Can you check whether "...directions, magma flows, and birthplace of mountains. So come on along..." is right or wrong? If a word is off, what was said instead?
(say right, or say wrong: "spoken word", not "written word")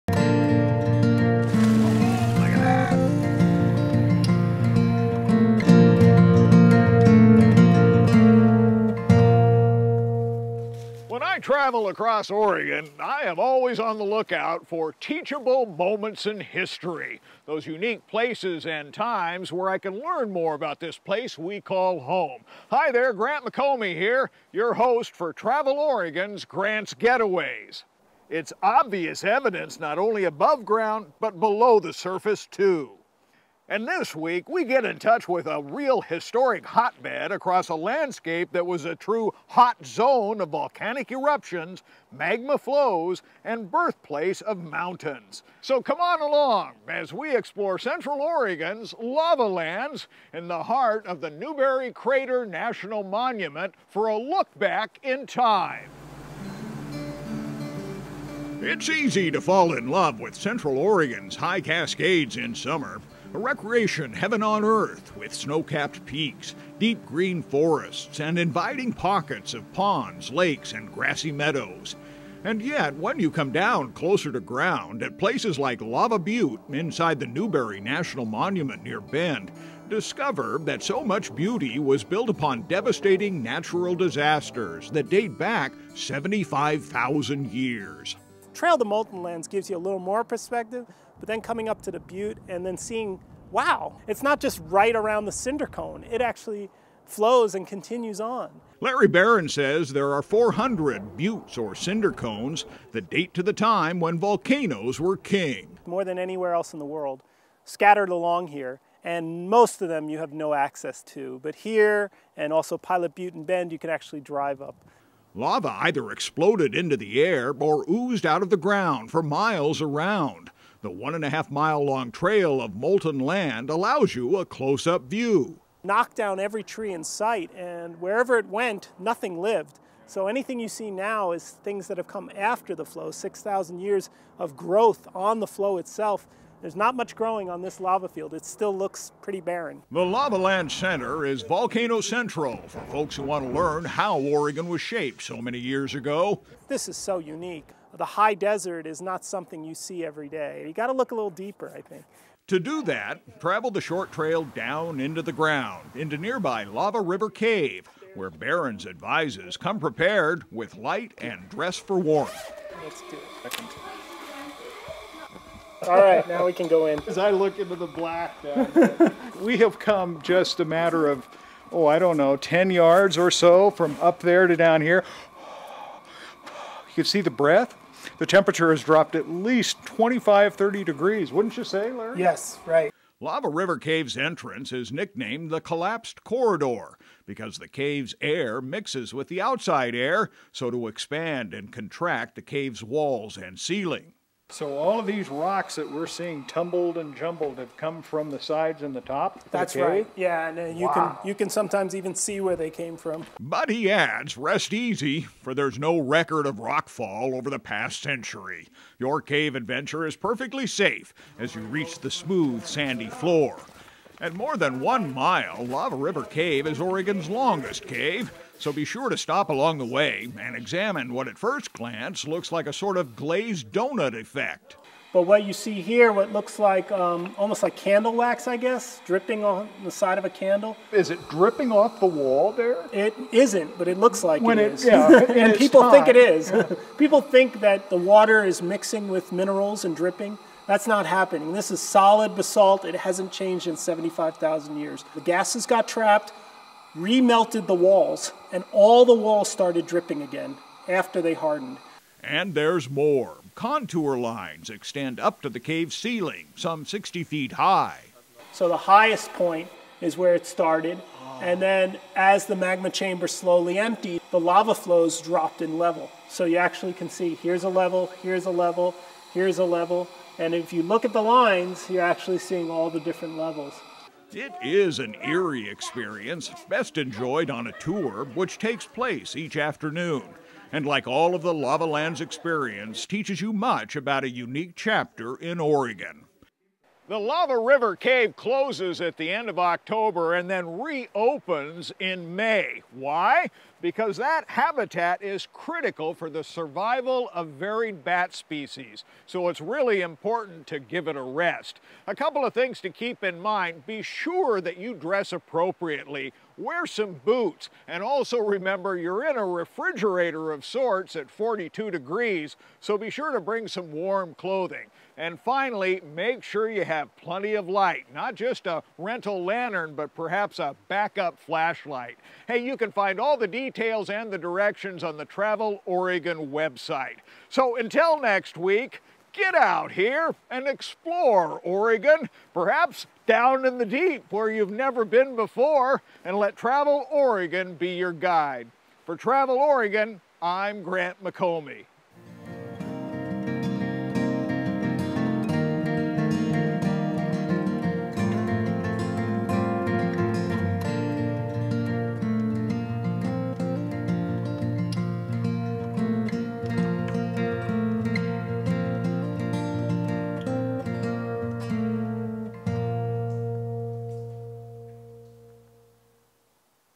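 wrong: "eruptions", not "directions".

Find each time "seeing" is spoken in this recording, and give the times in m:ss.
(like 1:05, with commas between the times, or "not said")
1:32, 3:16, 4:32.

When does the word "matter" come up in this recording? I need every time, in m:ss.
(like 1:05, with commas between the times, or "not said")
2:50.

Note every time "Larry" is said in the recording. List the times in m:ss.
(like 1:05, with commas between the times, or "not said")
1:38, 3:01.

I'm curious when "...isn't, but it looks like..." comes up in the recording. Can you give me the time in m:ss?
3:53.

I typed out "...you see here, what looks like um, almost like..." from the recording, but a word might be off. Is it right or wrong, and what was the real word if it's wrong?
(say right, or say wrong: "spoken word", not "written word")
right.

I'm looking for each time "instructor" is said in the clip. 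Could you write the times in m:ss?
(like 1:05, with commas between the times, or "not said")
not said.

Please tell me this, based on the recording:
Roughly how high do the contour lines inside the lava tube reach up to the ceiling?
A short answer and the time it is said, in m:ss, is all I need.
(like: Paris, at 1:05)
60 feet, at 4:16.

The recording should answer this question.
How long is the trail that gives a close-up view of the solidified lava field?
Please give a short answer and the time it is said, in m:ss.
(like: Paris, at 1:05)
1.5 miles, at 2:00.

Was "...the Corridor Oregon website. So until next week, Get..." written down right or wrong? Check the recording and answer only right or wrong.
wrong.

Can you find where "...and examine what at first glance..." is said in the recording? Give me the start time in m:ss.
3:40.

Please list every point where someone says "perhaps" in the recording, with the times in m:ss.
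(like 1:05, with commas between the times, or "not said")
5:20, 5:32.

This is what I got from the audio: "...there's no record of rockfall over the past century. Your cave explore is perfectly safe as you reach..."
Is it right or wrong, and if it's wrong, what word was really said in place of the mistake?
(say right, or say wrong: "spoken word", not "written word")
wrong: "adventure", not "explore".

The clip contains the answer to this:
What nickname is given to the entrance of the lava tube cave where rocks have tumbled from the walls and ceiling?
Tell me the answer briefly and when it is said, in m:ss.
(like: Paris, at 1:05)
Collapsed Corridor, at 3:05.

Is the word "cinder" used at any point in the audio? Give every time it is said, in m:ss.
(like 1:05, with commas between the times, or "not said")
1:35, 1:41.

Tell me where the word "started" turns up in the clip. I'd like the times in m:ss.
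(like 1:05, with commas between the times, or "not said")
4:09, 4:20.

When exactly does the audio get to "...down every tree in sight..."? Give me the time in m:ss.
2:06.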